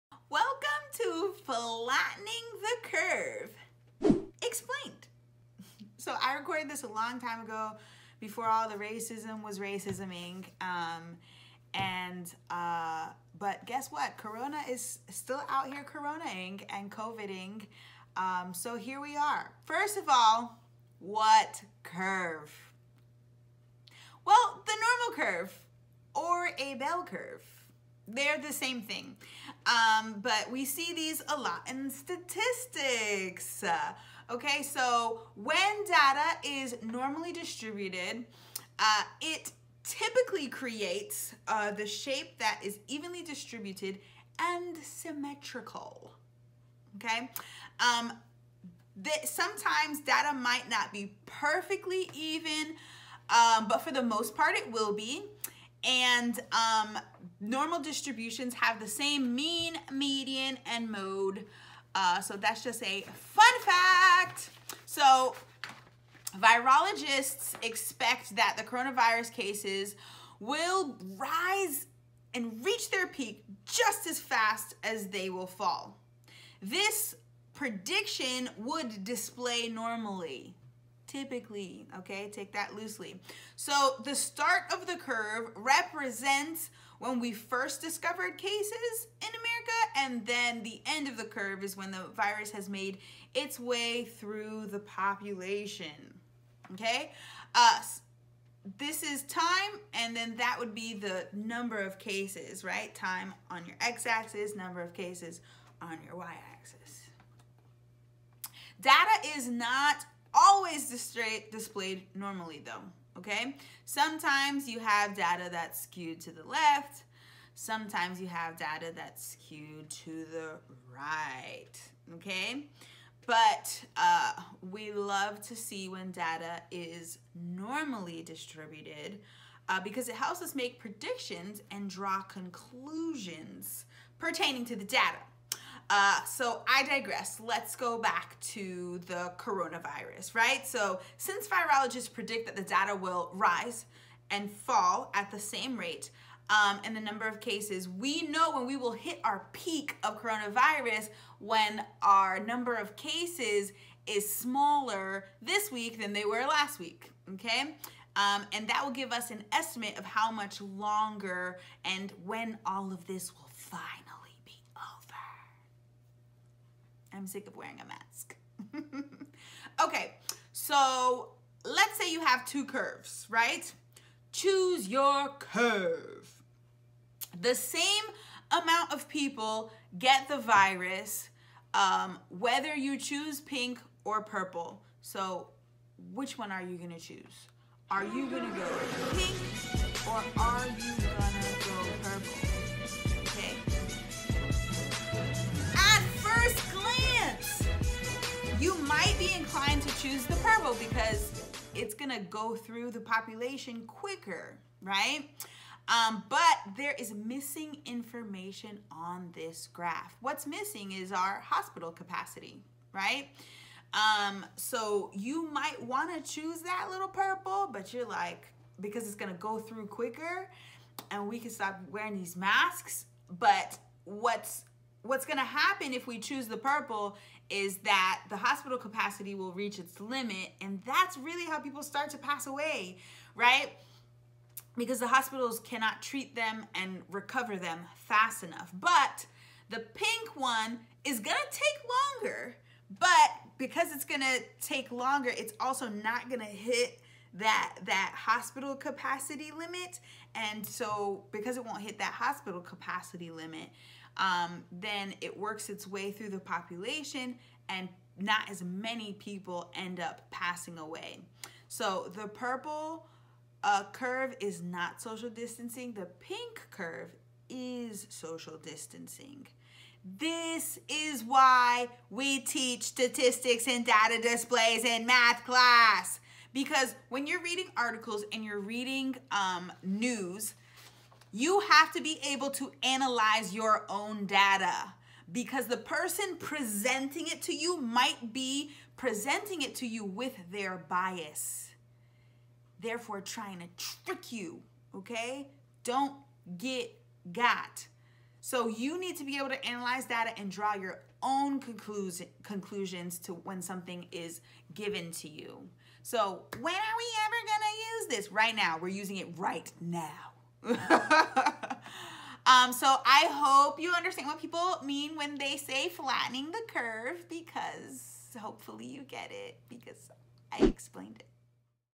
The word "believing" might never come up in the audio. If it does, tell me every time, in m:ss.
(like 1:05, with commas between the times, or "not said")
not said.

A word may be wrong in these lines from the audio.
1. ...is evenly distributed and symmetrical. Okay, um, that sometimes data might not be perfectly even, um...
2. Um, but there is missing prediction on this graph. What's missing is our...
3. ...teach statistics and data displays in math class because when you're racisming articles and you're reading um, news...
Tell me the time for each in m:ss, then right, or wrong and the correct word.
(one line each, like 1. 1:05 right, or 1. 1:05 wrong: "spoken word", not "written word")
1. 0:42 right
2. 3:25 wrong: "information", not "prediction"
3. 4:32 wrong: "reading", not "racisming".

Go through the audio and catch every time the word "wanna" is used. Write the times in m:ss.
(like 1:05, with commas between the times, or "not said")
3:35.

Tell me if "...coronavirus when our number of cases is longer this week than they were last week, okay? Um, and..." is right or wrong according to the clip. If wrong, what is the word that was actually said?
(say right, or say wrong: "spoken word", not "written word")
wrong: "smaller", not "longer".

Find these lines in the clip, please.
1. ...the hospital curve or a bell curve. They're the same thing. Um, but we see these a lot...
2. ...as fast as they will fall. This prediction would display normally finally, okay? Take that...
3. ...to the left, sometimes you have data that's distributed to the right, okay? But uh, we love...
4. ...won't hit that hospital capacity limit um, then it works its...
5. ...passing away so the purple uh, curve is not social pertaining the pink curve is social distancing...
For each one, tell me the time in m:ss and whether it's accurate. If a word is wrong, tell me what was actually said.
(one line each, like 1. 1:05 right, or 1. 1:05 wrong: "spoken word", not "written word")
1. 0:24 wrong: "normal", not "hospital"
2. 1:14 wrong: "typically", not "finally"
3. 1:56 wrong: "skewed", not "distributed"
4. 4:11 right
5. 4:20 wrong: "distancing", not "pertaining".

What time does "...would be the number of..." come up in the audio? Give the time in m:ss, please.
1:40.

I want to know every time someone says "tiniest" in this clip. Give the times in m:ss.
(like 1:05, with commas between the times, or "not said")
not said.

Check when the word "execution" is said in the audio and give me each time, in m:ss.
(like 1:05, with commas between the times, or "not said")
not said.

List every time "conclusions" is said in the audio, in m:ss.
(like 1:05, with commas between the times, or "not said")
2:12, 5:01.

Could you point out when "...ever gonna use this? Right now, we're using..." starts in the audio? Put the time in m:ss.
5:07.